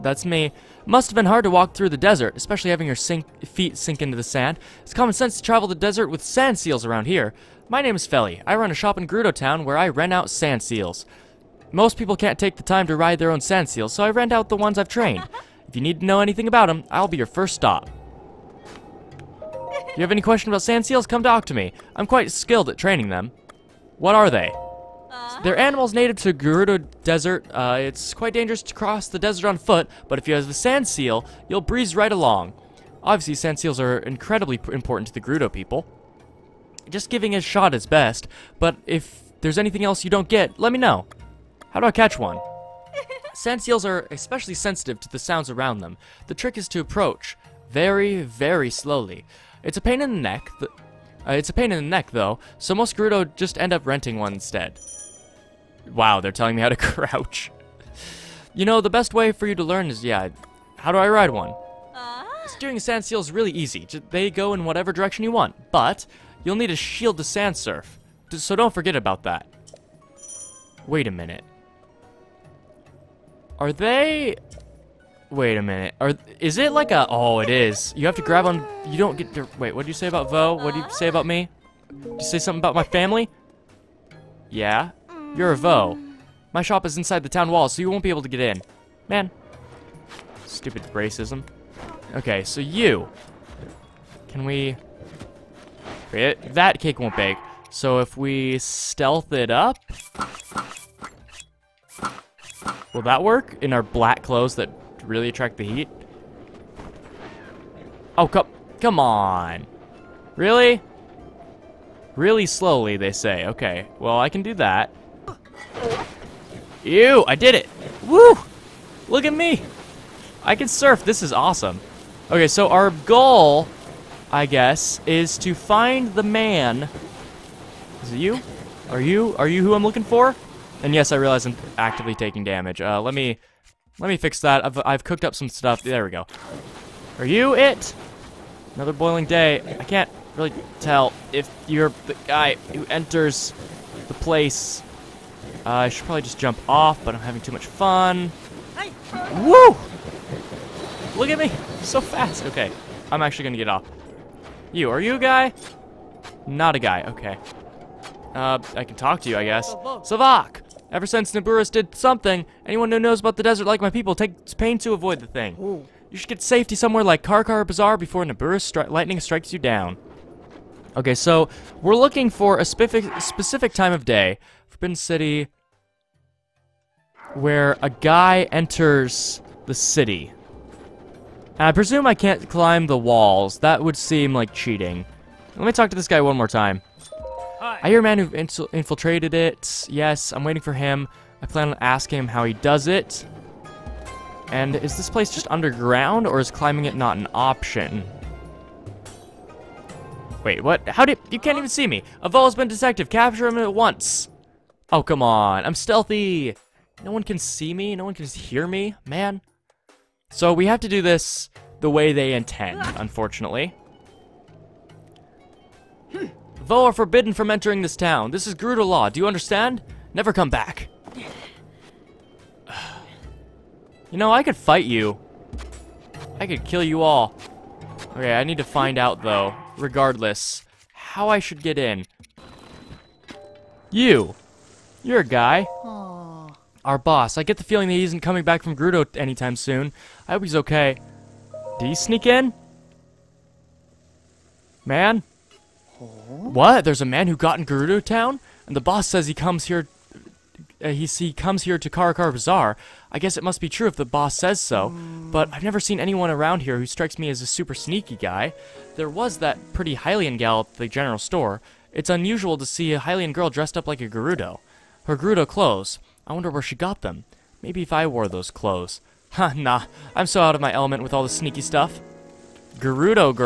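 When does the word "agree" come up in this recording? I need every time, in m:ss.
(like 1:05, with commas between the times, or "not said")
not said.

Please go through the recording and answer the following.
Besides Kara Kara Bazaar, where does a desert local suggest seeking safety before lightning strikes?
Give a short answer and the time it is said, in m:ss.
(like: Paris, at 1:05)
Karkar, at 2:47.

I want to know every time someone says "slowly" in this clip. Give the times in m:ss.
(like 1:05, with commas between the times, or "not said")
0:48, 1:52.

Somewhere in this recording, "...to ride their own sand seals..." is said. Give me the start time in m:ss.
0:12.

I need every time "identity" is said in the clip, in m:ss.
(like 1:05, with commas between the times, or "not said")
not said.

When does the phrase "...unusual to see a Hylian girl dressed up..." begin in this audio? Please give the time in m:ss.
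4:22.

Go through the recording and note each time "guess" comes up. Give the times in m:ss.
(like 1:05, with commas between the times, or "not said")
2:04, 2:39, 4:13.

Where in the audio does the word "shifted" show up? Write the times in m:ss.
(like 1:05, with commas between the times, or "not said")
not said.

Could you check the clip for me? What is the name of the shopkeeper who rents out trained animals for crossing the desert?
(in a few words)
Feli.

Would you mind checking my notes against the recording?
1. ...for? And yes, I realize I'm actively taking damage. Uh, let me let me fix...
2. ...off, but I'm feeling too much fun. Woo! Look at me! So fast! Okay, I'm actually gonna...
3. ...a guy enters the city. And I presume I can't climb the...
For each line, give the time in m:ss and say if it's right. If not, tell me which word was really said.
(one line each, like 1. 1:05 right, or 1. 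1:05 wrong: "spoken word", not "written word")
1. 2:10 right
2. 2:26 wrong: "having", not "feeling"
3. 2:57 right.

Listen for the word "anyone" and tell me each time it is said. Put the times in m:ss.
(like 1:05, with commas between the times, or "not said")
2:42, 4:15.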